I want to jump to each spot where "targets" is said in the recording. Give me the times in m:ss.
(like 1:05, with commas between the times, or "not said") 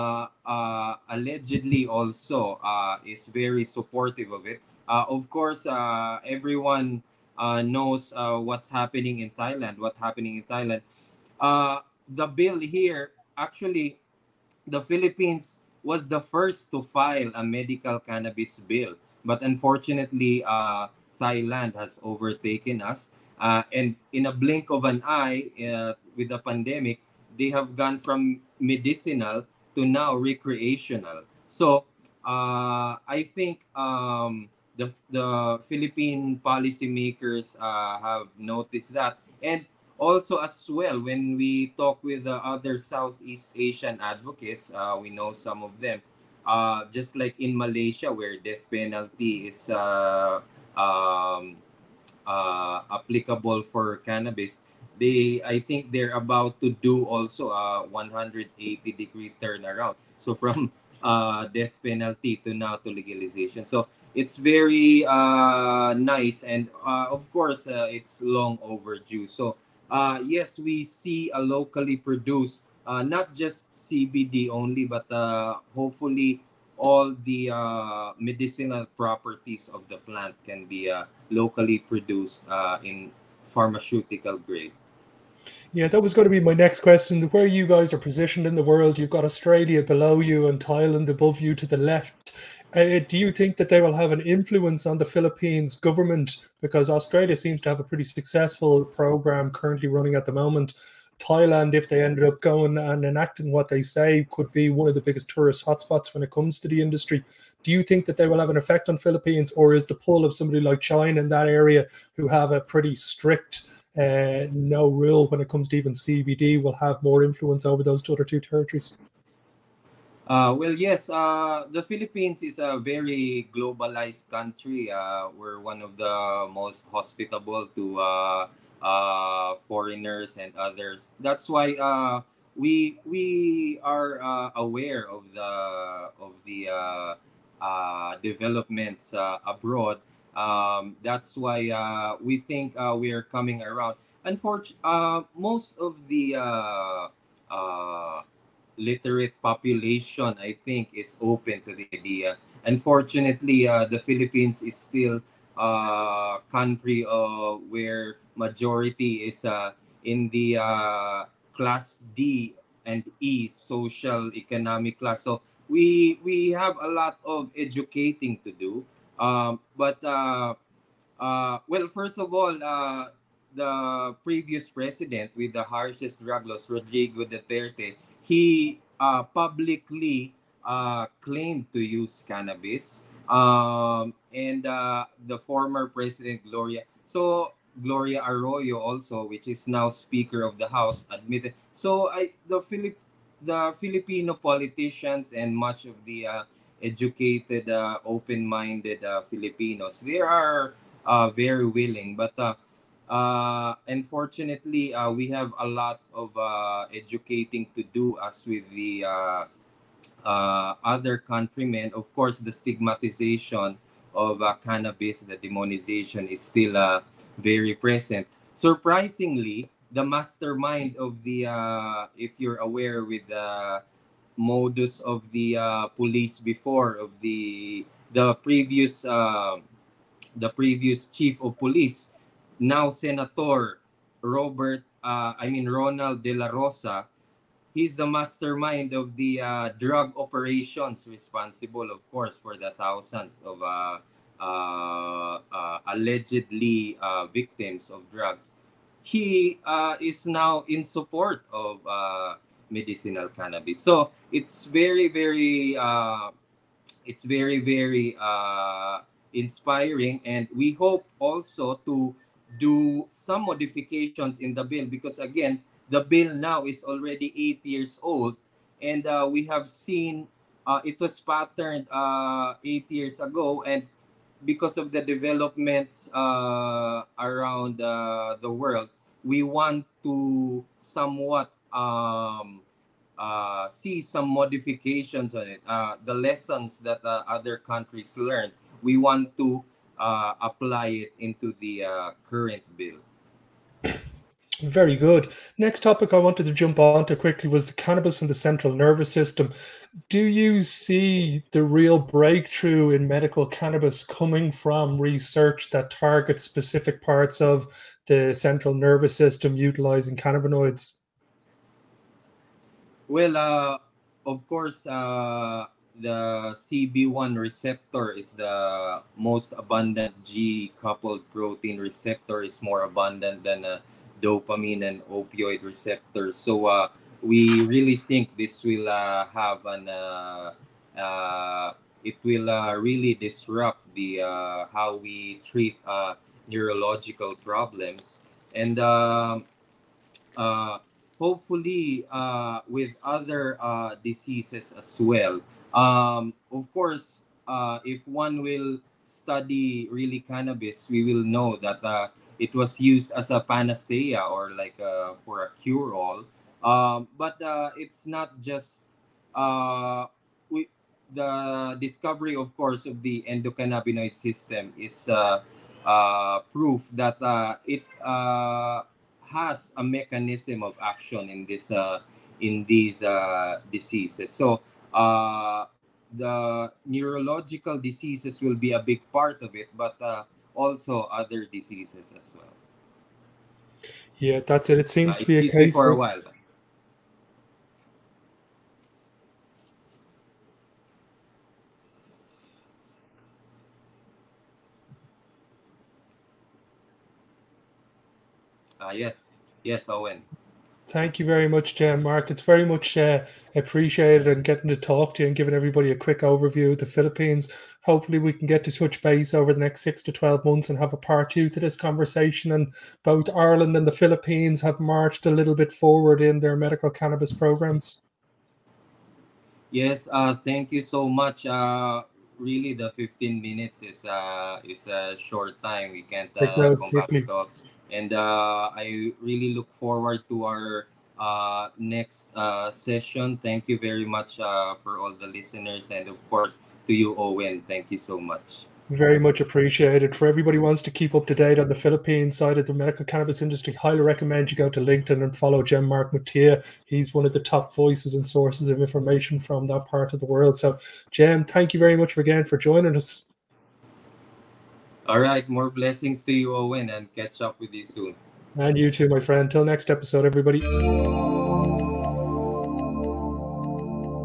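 5:05.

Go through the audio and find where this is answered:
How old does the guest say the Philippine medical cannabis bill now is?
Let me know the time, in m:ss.
4:27.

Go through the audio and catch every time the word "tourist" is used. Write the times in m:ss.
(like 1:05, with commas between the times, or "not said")
1:45.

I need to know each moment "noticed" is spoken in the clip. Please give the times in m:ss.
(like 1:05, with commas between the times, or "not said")
0:38.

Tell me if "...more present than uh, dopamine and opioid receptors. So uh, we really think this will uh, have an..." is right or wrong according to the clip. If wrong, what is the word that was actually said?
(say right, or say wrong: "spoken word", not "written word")
wrong: "abundant", not "present".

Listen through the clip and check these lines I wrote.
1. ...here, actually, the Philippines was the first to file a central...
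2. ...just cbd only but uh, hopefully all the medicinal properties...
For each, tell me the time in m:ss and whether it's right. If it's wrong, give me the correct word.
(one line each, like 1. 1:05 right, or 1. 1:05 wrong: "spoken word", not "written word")
1. 0:12 wrong: "medical", not "central"
2. 1:13 right.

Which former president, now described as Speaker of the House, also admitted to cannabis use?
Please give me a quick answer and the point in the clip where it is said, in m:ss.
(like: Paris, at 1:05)
Gloria Arroyo, at 3:07.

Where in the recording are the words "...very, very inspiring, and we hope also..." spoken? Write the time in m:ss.
4:17.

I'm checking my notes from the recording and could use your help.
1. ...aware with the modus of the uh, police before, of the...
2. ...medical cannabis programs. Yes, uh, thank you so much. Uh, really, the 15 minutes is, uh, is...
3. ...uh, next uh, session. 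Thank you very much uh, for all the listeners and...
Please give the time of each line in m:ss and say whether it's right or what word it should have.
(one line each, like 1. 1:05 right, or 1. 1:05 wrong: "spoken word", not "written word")
1. 3:42 right
2. 6:56 right
3. 7:11 right.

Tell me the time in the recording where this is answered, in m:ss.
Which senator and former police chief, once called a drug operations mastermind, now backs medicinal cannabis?
3:55.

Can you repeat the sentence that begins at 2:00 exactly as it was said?
Uh, well, yes, uh, the Philippines is a very globalized country.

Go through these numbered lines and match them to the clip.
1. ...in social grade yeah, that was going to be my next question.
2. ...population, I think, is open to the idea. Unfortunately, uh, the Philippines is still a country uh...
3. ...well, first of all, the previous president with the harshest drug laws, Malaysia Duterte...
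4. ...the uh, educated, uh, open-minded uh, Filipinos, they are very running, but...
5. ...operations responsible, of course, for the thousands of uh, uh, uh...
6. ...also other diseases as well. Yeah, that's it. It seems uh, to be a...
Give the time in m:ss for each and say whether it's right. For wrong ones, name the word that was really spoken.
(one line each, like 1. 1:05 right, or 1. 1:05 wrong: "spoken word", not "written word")
1. 1:22 wrong: "pharmaceutical", not "social"
2. 2:29 right
3. 2:51 wrong: "Rodrigo", not "Malaysia"
4. 3:16 wrong: "willing", not "running"
5. 4:00 right
6. 6:20 right.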